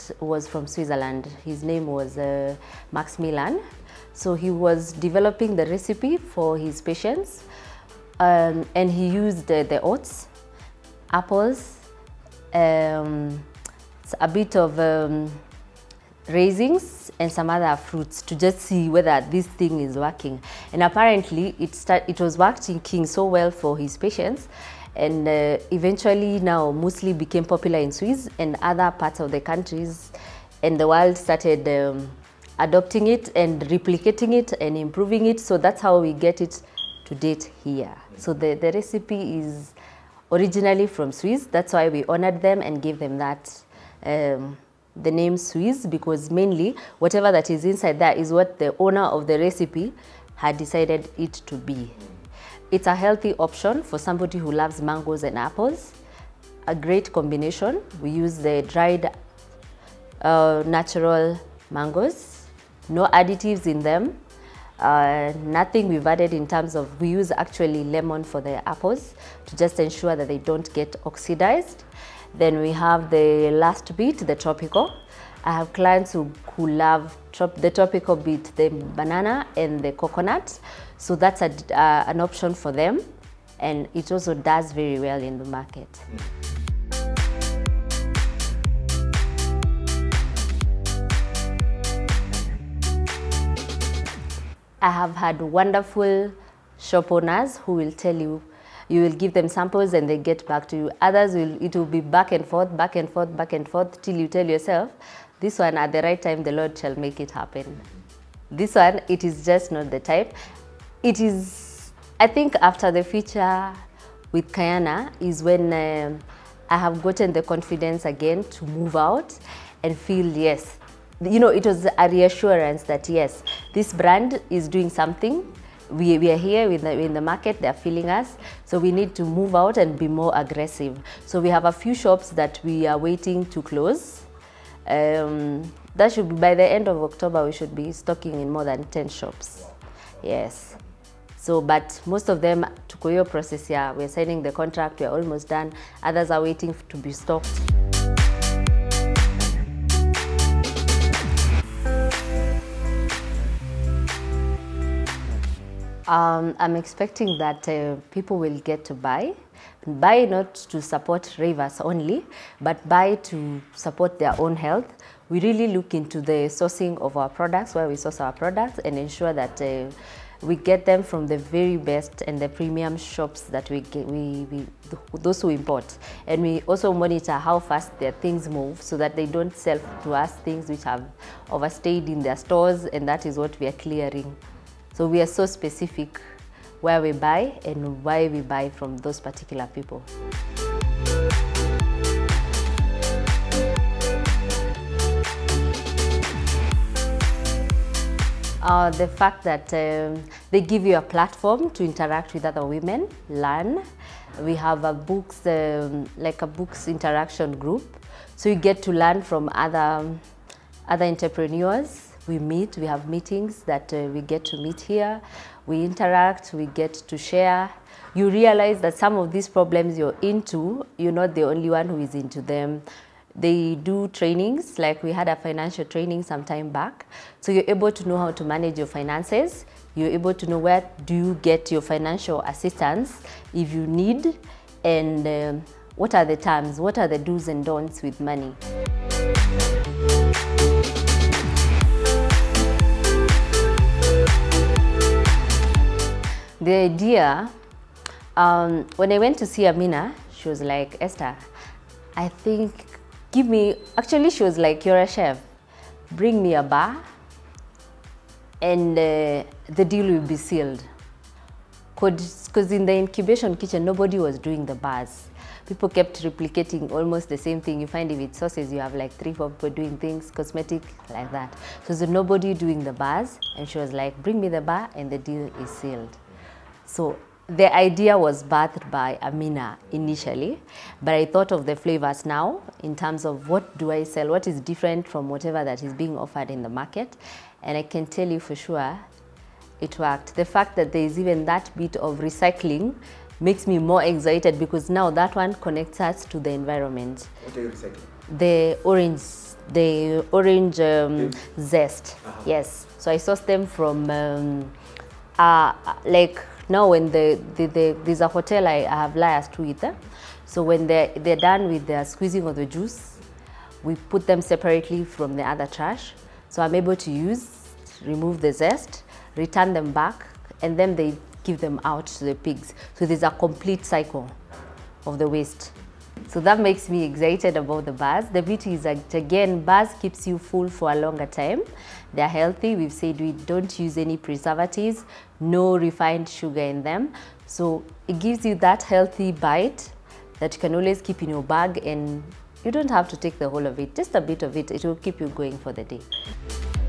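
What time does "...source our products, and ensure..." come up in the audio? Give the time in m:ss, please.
2:47.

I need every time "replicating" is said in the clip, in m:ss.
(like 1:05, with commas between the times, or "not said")
0:33, 4:26.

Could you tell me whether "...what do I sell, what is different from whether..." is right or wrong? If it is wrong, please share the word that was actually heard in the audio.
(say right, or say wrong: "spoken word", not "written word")
wrong: "whatever", not "whether".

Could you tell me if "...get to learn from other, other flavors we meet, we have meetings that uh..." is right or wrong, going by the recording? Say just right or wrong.
wrong.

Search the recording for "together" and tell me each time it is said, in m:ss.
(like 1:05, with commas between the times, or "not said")
not said.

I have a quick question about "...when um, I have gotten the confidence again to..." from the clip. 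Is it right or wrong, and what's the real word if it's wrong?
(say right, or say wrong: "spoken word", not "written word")
right.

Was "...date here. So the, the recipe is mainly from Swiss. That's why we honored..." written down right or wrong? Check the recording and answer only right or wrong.
wrong.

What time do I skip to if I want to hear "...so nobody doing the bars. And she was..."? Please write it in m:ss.
4:31.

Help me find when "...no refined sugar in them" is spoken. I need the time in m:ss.
5:35.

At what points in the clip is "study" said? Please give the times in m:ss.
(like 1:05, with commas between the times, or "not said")
not said.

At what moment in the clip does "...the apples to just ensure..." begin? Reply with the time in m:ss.
1:08.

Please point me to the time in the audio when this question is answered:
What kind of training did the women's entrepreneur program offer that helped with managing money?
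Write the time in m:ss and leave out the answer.
3:45.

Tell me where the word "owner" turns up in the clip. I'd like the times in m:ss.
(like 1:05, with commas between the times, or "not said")
0:48, 1:37.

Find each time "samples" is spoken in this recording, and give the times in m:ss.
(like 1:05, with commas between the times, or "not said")
1:39.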